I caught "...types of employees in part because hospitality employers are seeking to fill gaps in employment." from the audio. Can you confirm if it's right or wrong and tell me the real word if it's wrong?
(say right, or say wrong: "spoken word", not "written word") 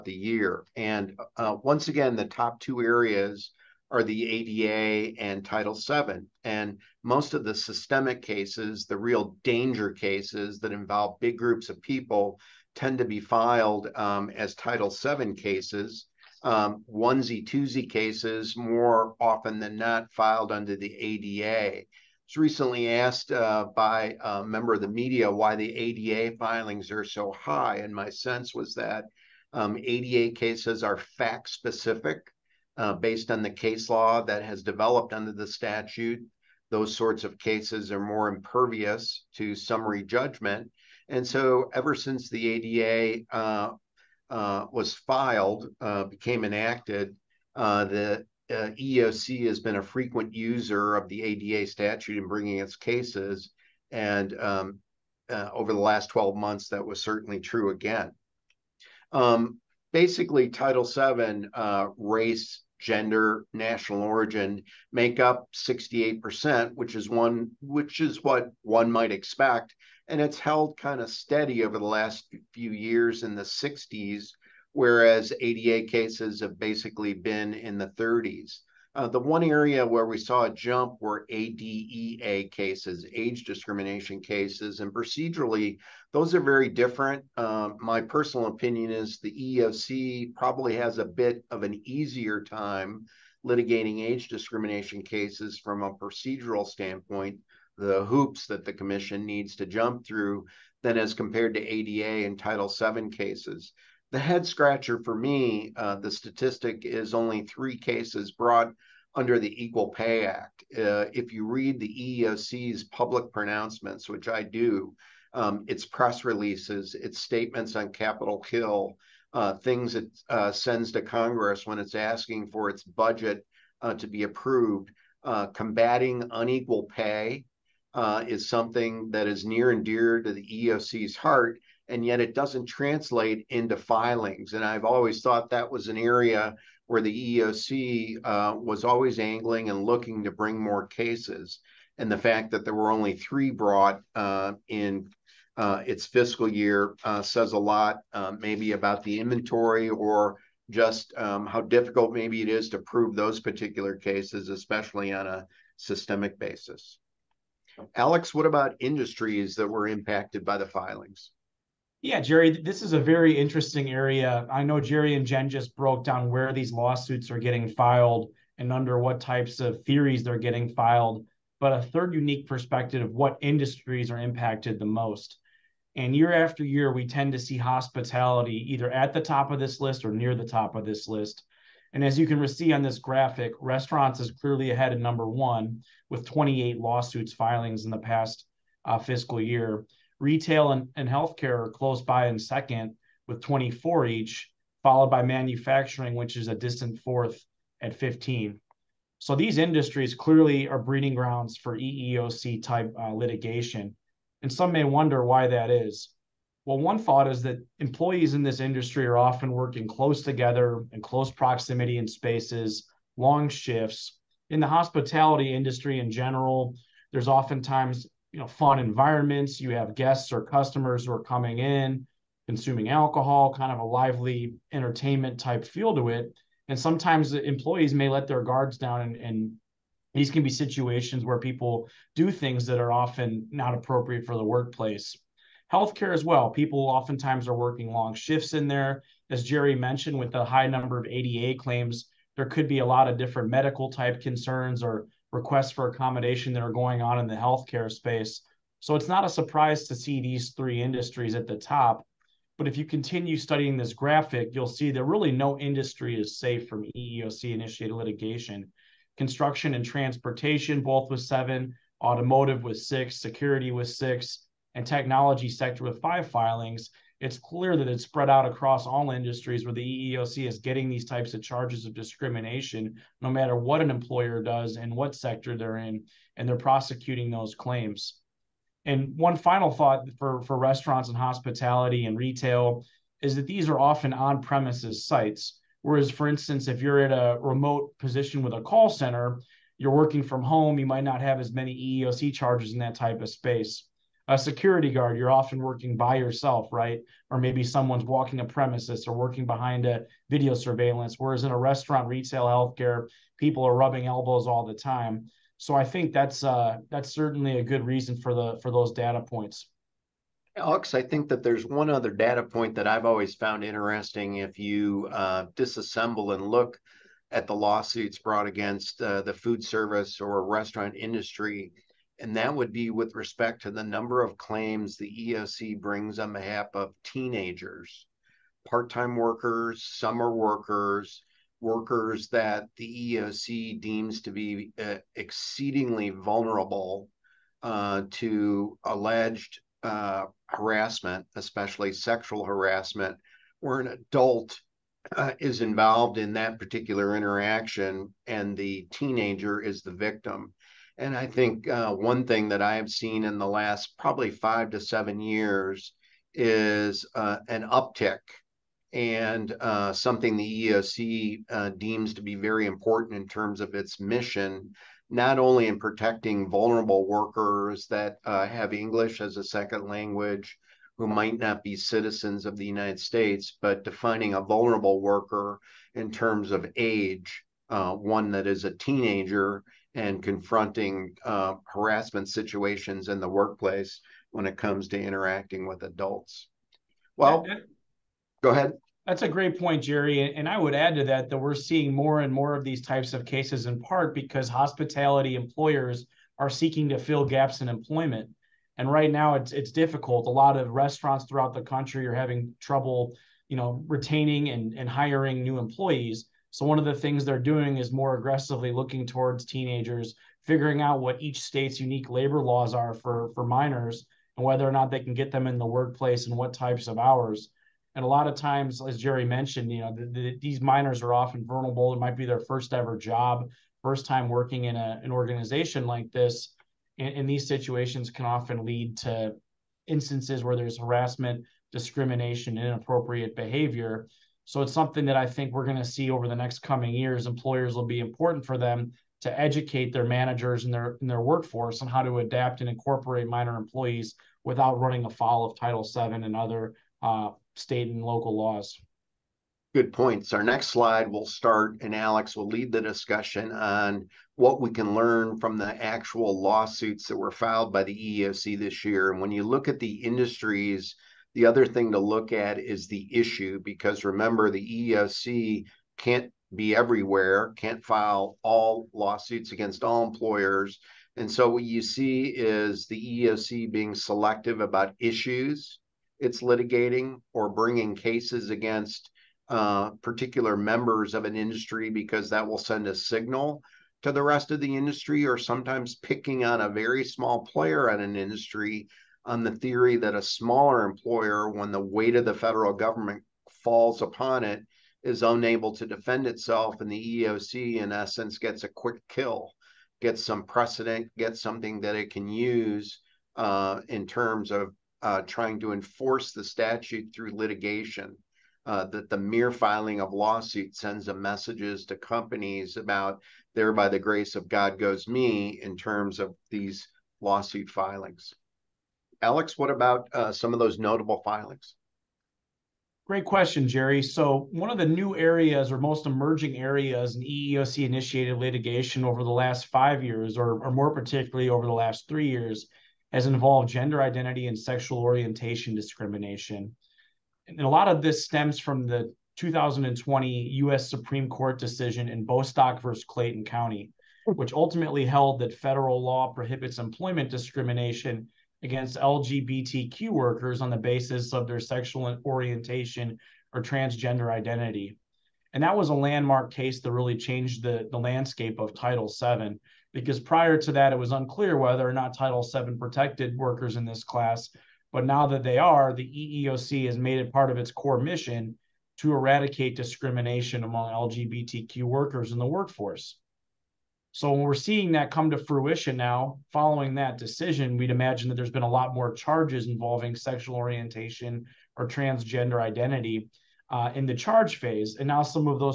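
wrong: "cases", not "employees".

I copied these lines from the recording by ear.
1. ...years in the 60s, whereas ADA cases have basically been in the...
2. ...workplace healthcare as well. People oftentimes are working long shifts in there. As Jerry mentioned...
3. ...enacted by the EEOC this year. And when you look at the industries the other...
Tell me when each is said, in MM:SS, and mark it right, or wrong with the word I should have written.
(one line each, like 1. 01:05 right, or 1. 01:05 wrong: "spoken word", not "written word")
1. 01:12 right
2. 03:54 right
3. 07:37 wrong: "filed", not "enacted".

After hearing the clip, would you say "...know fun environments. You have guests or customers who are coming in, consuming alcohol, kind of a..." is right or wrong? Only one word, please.
right.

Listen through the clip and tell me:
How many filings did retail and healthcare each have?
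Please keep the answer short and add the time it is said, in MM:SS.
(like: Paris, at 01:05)
24, at 03:13.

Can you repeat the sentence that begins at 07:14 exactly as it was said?
So it's something that I think we're going to see over the next coming years.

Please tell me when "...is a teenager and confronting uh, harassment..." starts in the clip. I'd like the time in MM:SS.
06:18.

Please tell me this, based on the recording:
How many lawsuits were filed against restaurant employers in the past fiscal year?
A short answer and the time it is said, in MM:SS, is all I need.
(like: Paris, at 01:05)
28, at 03:06.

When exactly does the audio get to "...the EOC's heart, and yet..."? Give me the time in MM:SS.
02:10.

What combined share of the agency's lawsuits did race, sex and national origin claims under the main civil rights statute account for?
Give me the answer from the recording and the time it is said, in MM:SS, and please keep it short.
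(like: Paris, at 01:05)
68%, at 01:05.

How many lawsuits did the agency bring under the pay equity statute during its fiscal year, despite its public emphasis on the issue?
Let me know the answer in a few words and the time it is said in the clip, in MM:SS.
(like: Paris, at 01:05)
3, at 01:47.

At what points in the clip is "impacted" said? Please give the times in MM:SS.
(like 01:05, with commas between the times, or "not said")
02:39, 02:54.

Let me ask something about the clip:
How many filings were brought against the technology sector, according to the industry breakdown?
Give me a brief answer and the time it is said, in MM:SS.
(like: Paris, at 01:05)
5, at 04:26.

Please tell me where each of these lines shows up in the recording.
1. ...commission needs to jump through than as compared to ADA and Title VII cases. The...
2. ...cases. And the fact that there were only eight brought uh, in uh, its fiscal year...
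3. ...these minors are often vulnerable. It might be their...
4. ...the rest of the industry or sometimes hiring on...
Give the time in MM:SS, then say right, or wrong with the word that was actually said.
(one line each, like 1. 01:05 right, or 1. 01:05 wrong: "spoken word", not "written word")
1. 01:38 right
2. 02:20 wrong: "three", not "eight"
3. 07:00 right
4. 08:04 wrong: "picking", not "hiring".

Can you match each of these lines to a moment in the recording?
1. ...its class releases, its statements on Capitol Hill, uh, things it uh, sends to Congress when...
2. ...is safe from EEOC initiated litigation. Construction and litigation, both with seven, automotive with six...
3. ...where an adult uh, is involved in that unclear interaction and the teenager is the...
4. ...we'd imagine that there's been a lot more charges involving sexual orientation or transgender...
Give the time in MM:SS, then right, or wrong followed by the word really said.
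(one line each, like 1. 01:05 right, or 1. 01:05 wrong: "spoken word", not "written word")
1. 01:55 wrong: "press", not "class"
2. 04:16 wrong: "transportation", not "litigation"
3. 05:43 wrong: "particular", not "unclear"
4. 09:37 right.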